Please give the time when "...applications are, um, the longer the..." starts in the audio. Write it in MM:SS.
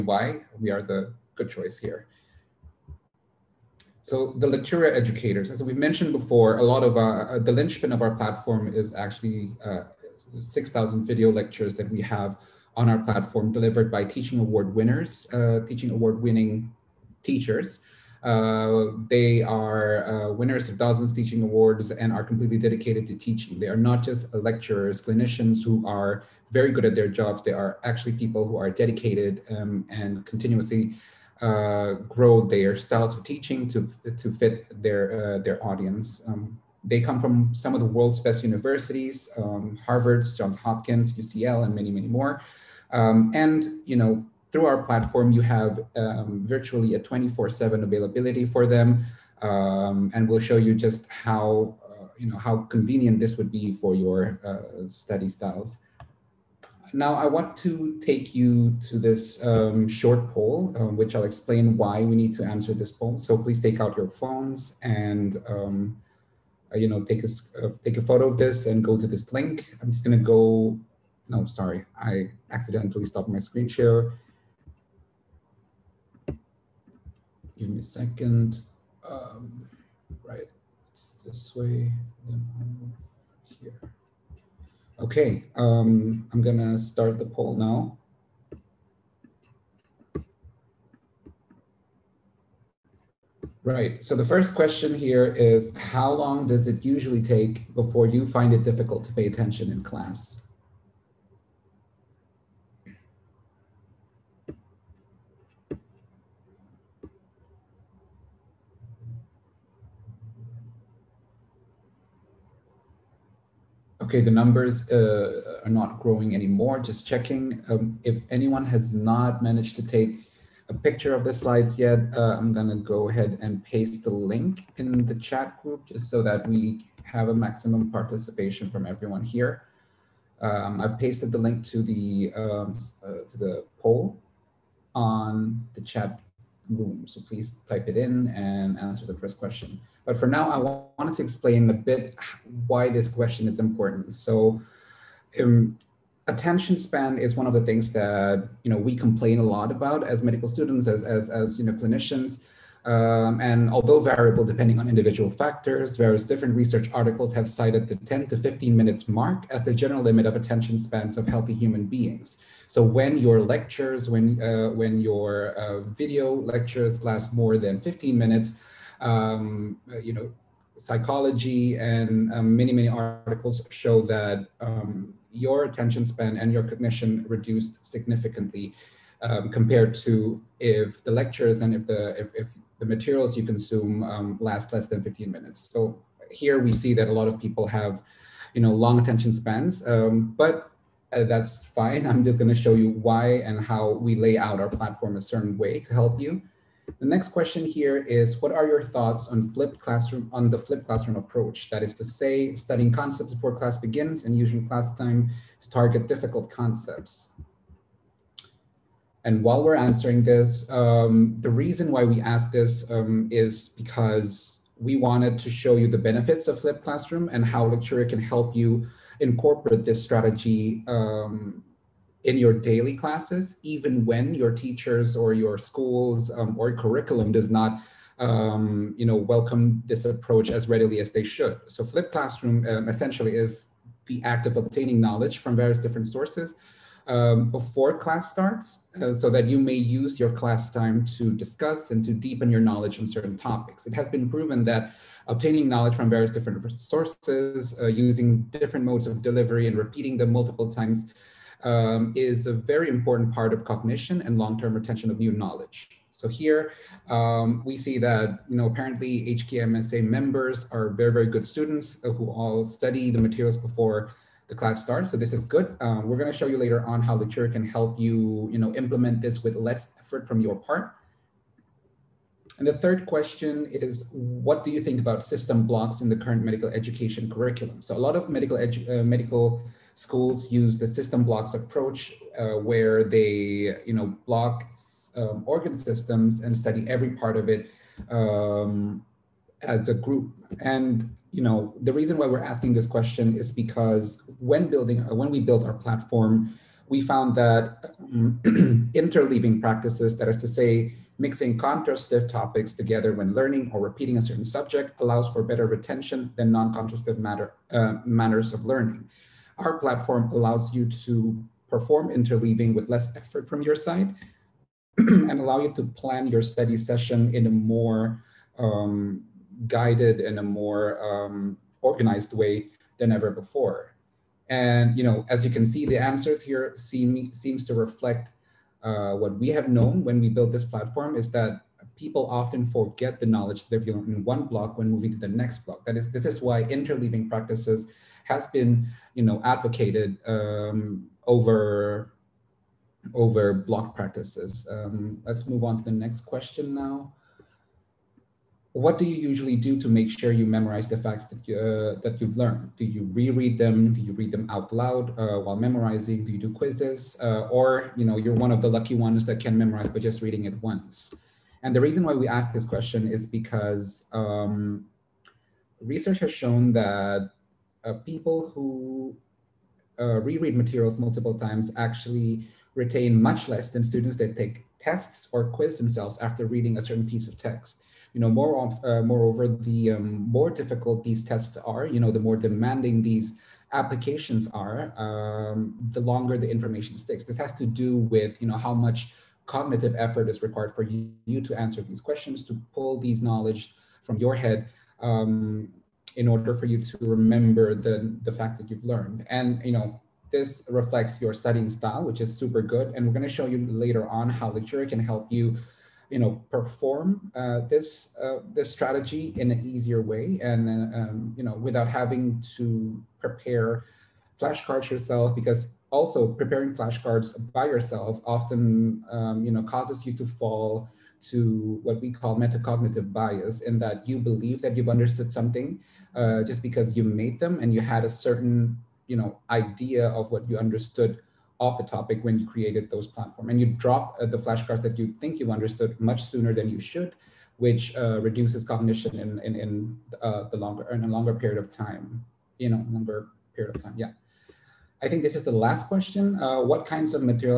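06:23.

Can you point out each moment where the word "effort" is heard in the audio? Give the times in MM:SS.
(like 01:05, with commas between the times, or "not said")
04:29, 05:13, 06:29.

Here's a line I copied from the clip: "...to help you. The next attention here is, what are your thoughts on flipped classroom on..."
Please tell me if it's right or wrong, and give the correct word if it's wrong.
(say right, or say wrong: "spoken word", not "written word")
wrong: "question", not "attention".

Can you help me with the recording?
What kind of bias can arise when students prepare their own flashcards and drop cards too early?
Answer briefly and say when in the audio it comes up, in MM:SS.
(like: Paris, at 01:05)
metacognitive bias, at 07:02.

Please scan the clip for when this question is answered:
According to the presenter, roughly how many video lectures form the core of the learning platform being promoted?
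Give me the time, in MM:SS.
00:10.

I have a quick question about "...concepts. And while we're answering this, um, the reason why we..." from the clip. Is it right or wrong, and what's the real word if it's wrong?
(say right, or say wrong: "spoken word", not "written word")
right.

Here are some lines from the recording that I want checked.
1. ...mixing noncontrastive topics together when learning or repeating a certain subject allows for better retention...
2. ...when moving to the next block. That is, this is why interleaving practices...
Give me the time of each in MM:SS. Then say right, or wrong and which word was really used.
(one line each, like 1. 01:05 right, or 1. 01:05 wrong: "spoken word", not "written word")
1. 05:01 wrong: "contrastive", not "noncontrastive"
2. 05:34 right.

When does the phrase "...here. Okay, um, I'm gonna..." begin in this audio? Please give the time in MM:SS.
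01:23.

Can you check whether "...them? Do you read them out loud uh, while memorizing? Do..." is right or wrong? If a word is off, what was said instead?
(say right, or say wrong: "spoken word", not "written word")
right.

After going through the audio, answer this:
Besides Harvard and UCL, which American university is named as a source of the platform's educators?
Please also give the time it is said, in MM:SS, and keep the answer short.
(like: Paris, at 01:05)
Johns Hopkins, at 00:40.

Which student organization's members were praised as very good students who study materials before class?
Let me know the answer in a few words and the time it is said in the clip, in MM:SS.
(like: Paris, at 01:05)
HKMSA, at 04:19.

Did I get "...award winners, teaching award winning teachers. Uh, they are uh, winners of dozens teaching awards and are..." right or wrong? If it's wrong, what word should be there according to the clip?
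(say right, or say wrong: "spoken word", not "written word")
right.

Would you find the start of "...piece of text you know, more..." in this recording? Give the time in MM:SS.
06:17.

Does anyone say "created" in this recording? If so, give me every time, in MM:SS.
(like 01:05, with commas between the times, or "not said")
07:12.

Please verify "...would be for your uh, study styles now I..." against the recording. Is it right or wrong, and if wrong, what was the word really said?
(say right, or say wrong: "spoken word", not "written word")
right.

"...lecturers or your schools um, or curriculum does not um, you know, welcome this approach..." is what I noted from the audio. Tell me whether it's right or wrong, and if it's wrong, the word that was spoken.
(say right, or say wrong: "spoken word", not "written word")
wrong: "teachers", not "lecturers".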